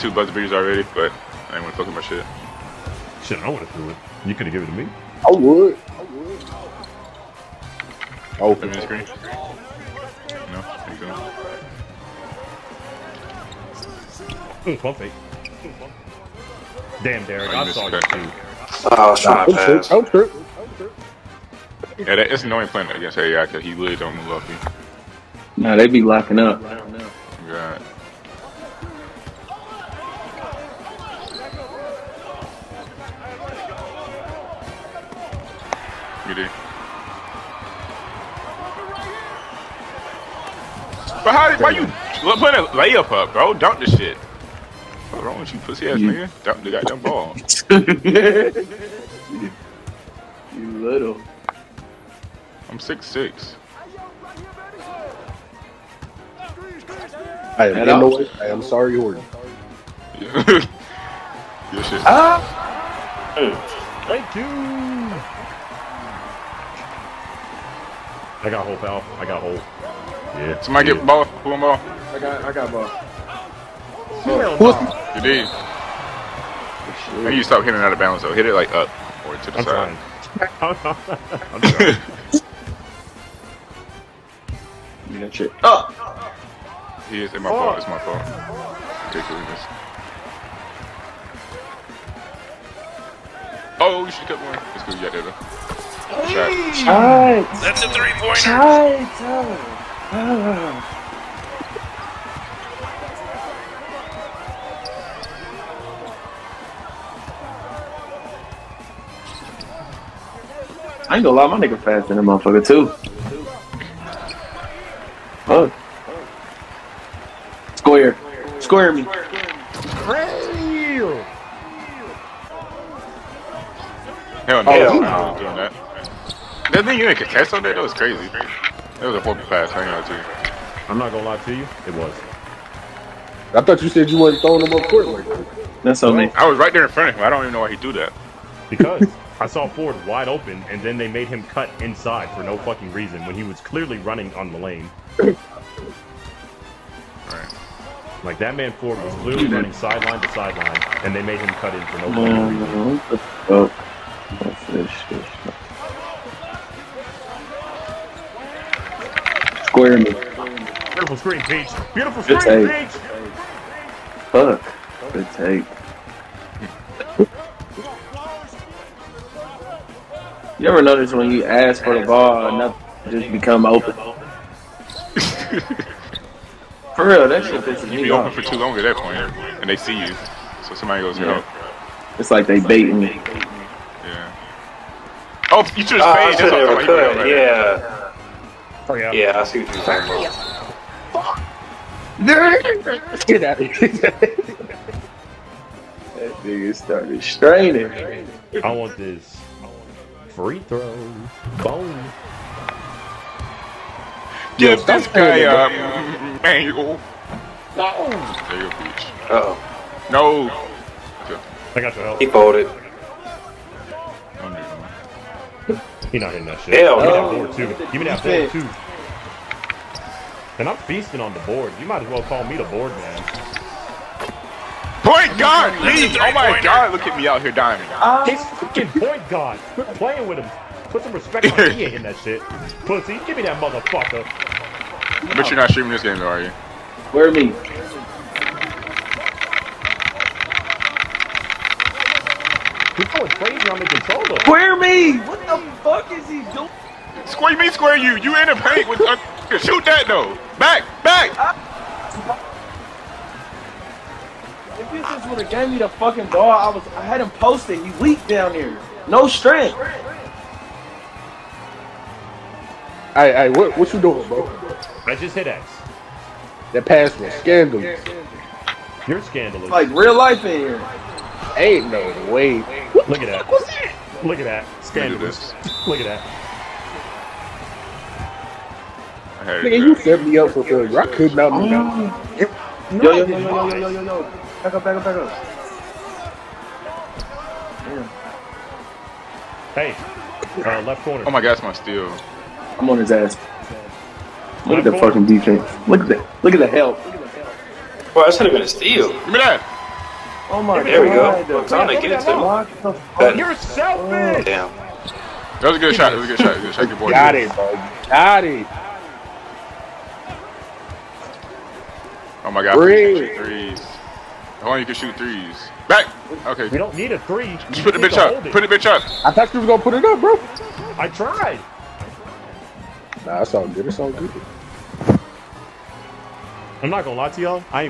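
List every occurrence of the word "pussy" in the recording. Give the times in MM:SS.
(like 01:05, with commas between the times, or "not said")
00:45, 03:52.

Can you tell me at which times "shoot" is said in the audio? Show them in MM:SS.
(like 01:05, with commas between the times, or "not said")
04:09, 05:14.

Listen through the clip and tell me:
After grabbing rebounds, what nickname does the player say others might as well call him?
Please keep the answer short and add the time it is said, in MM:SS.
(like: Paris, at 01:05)
the board man, at 03:42.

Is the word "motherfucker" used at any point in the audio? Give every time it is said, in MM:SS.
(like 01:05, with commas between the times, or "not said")
01:52, 03:53.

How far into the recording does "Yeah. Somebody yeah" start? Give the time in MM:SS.
01:10.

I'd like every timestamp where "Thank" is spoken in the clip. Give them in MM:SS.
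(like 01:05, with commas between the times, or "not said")
01:04.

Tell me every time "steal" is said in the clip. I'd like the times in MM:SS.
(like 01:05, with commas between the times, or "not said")
04:51, 04:58.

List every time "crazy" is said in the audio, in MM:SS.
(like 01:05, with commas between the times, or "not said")
02:07, 04:03.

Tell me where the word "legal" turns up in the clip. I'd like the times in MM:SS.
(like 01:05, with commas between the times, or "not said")
not said.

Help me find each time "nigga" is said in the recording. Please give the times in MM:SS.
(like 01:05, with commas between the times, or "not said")
00:45, 01:51, 03:16, 04:39.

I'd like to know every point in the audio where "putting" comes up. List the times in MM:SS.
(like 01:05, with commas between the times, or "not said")
00:42.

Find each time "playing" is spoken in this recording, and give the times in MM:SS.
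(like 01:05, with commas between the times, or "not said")
00:22, 03:49.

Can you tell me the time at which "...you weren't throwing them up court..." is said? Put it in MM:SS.
02:14.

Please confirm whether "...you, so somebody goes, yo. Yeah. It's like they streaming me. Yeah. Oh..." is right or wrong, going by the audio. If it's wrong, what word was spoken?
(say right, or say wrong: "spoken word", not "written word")
wrong: "baiting", not "streaming".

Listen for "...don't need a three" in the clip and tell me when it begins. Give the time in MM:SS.
05:16.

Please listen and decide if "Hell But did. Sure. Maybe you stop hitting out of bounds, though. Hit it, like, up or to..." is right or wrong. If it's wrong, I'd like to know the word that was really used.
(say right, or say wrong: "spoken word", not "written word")
wrong: "You", not "But".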